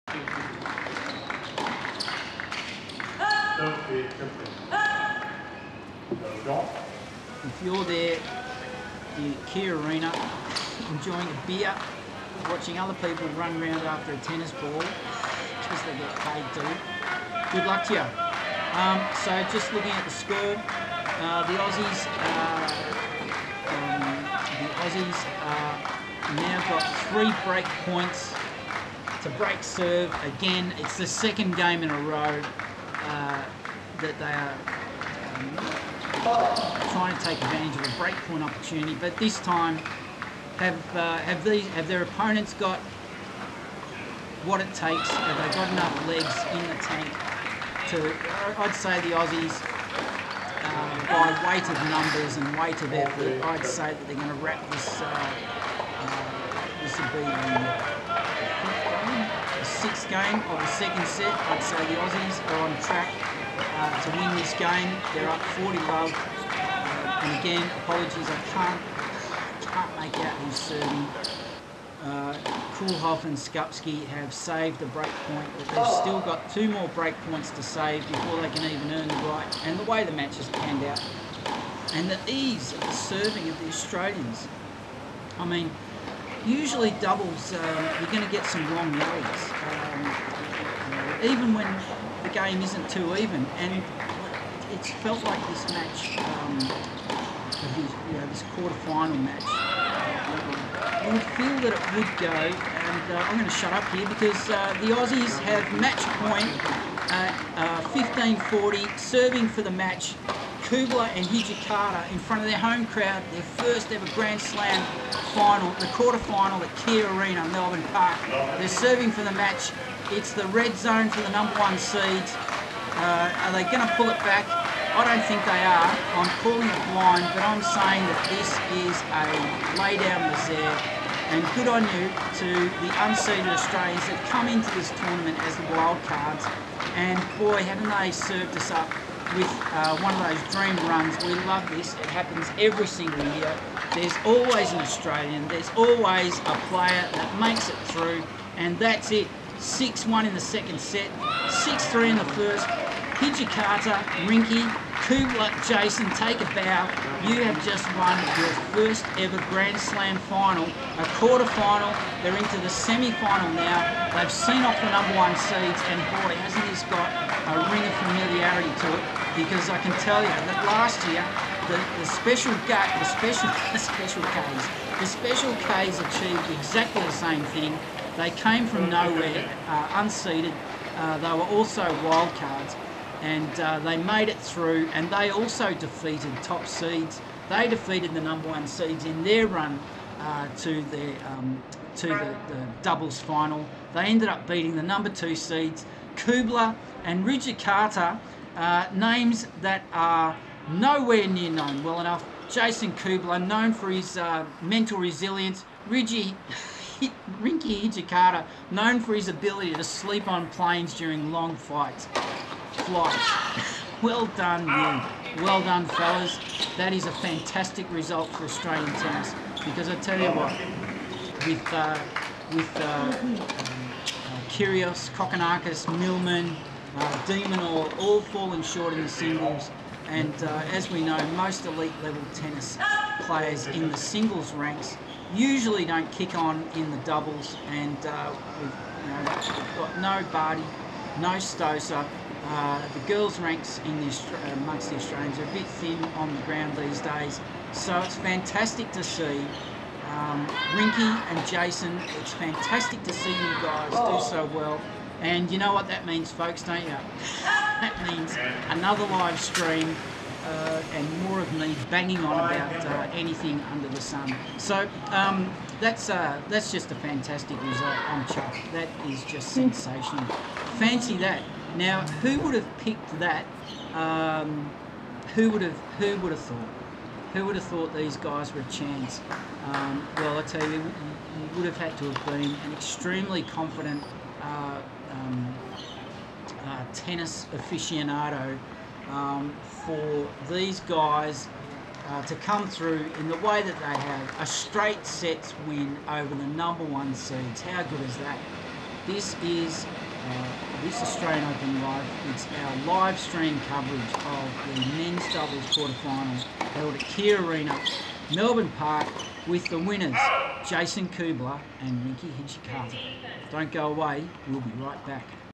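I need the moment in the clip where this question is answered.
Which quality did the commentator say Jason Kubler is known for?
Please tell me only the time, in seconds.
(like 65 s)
204 s.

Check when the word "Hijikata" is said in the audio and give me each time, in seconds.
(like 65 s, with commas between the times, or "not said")
111 s, 153 s, 206 s.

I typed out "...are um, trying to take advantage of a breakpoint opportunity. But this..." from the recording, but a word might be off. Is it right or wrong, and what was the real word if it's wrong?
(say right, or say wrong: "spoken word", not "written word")
right.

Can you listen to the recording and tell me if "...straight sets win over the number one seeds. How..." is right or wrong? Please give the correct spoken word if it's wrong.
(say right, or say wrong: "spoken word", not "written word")
right.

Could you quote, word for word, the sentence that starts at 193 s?
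They ended up beating the number two seeds, Kubler and Carter.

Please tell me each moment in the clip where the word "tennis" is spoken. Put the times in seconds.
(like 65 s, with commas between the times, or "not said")
14 s, 218 s, 232 s, 286 s.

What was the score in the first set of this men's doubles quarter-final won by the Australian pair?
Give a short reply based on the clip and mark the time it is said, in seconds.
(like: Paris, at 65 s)
6-3, at 151 s.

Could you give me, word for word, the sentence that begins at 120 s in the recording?
It's the red zone for the number one seeds.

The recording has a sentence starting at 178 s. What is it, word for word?
They came from nowhere, uh, unseeded.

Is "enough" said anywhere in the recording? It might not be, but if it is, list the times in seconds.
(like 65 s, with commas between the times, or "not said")
45 s, 202 s.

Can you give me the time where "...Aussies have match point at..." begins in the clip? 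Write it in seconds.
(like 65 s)
104 s.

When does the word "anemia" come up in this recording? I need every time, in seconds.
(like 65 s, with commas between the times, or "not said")
not said.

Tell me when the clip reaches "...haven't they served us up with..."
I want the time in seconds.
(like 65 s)
137 s.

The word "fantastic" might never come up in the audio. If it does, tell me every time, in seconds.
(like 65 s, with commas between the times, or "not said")
217 s, 248 s, 252 s, 266 s.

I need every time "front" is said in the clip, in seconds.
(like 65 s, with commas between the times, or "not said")
112 s.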